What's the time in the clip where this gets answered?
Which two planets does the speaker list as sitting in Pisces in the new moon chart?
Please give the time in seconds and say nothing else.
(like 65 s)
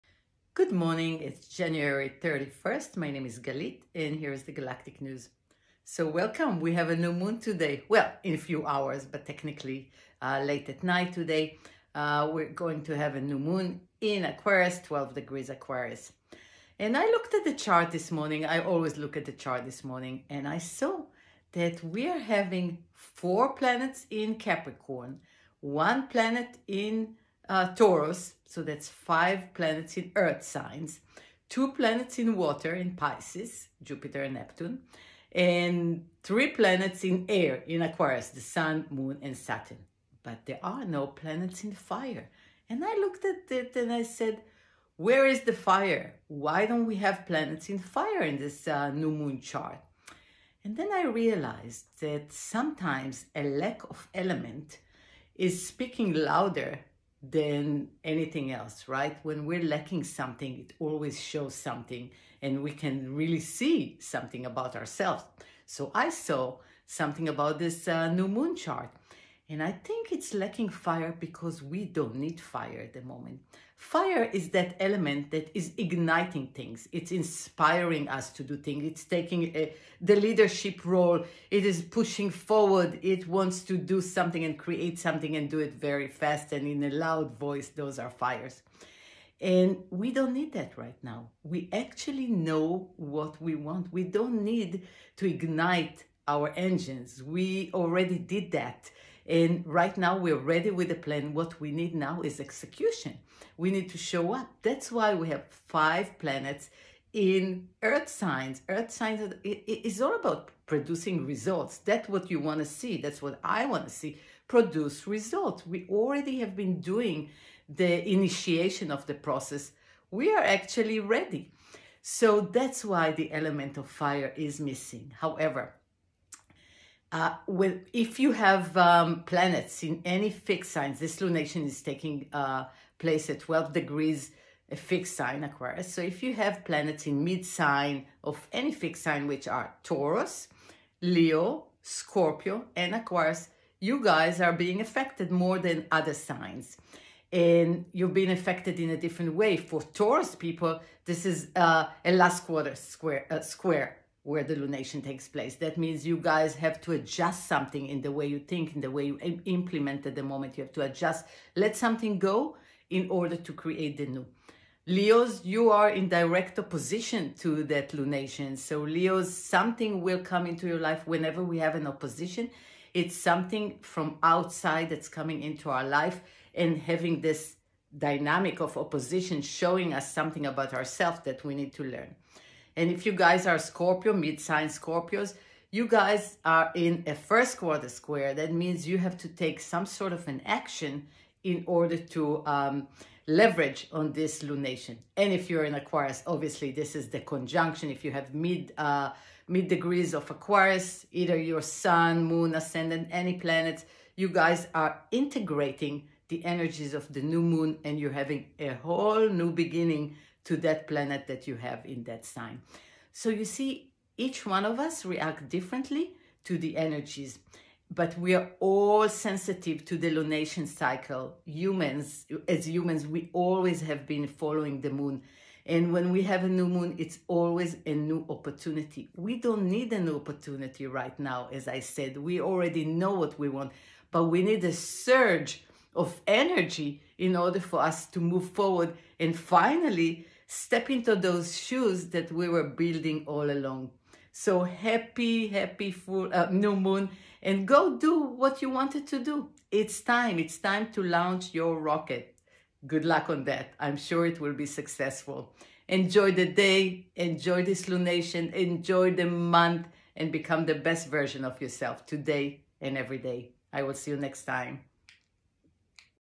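33 s.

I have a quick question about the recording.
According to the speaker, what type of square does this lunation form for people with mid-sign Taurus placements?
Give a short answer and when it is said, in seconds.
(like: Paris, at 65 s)
Last quarter square, at 152 s.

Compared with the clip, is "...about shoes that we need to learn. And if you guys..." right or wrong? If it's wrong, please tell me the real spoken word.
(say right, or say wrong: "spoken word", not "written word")
wrong: "ourselves", not "shoes".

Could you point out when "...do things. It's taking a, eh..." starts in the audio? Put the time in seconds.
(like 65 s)
78 s.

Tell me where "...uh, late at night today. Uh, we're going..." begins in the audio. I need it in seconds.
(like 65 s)
10 s.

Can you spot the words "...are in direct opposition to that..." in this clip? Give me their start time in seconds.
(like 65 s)
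165 s.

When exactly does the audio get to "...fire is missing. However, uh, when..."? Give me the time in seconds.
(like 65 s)
123 s.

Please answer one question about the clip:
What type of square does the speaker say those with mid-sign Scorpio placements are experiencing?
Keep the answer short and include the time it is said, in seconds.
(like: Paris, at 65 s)
First quarter square, at 187 s.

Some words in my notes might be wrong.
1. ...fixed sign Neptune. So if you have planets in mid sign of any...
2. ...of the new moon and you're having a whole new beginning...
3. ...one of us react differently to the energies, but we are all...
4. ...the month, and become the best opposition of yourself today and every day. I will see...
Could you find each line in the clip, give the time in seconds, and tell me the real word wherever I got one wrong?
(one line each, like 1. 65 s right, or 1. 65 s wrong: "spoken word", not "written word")
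1. 134 s wrong: "Aquarius", not "Neptune"
2. 206 s right
3. 214 s right
4. 259 s wrong: "version", not "opposition".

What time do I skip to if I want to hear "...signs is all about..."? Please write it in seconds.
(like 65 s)
108 s.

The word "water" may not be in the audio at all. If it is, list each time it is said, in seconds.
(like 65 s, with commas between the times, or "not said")
32 s.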